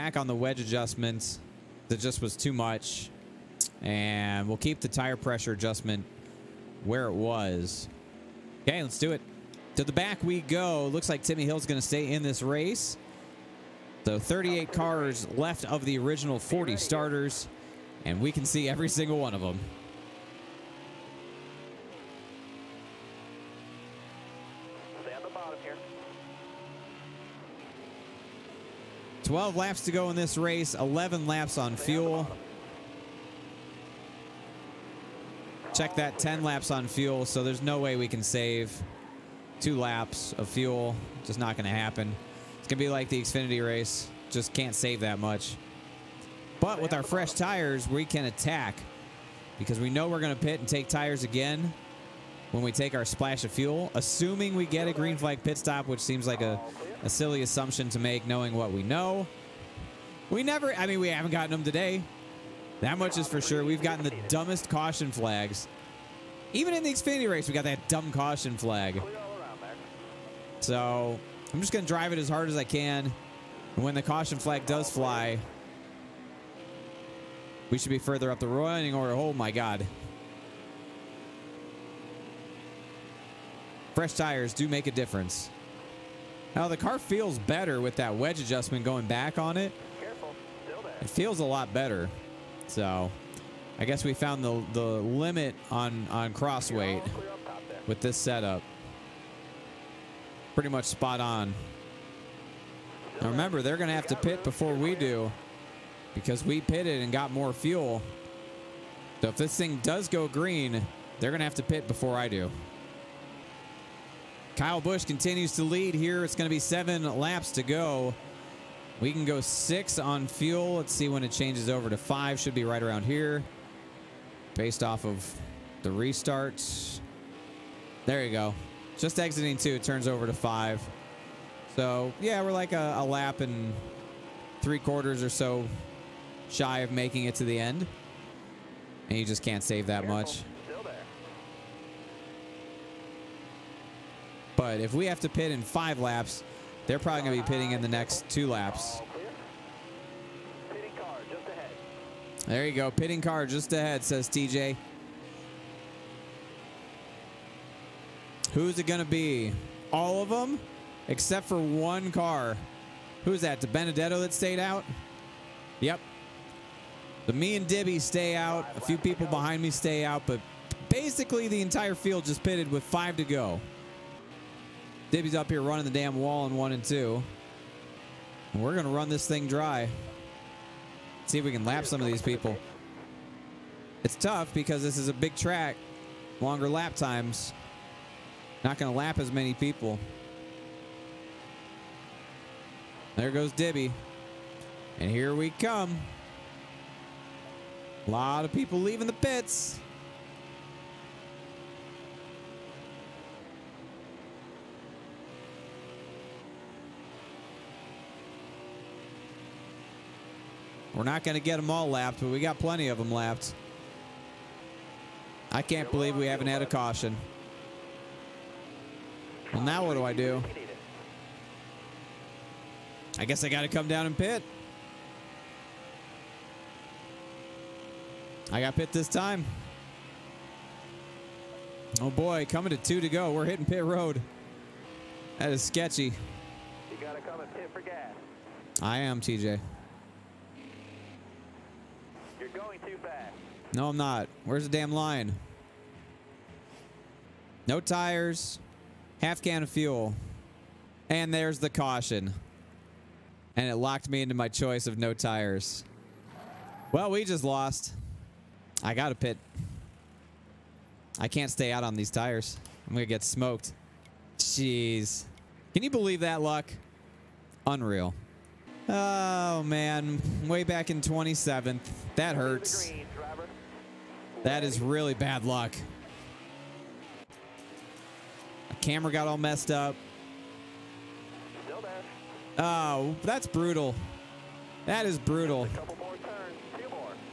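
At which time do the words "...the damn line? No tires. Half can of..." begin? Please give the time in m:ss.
4:04.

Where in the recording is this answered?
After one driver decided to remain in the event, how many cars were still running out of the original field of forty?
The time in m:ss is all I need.
0:14.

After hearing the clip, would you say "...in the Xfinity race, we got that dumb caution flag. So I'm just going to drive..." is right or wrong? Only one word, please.
right.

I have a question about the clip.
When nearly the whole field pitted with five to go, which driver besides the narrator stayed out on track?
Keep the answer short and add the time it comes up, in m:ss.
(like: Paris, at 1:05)
DiBenedetto, at 2:43.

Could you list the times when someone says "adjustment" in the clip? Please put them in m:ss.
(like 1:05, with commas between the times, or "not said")
0:00, 0:05, 1:28.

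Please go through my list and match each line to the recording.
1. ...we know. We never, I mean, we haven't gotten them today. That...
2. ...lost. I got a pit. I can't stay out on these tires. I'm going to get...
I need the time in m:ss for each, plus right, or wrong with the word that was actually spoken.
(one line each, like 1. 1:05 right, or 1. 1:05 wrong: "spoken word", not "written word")
1. 0:58 right
2. 4:17 right.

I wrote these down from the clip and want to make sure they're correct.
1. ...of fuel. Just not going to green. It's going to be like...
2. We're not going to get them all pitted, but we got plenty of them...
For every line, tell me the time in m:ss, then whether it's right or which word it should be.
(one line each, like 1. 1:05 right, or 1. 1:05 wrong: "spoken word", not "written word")
1. 0:40 wrong: "happen", not "green"
2. 3:30 wrong: "lapped", not "pitted".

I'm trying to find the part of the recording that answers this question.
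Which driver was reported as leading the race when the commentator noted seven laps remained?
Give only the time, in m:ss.
1:54.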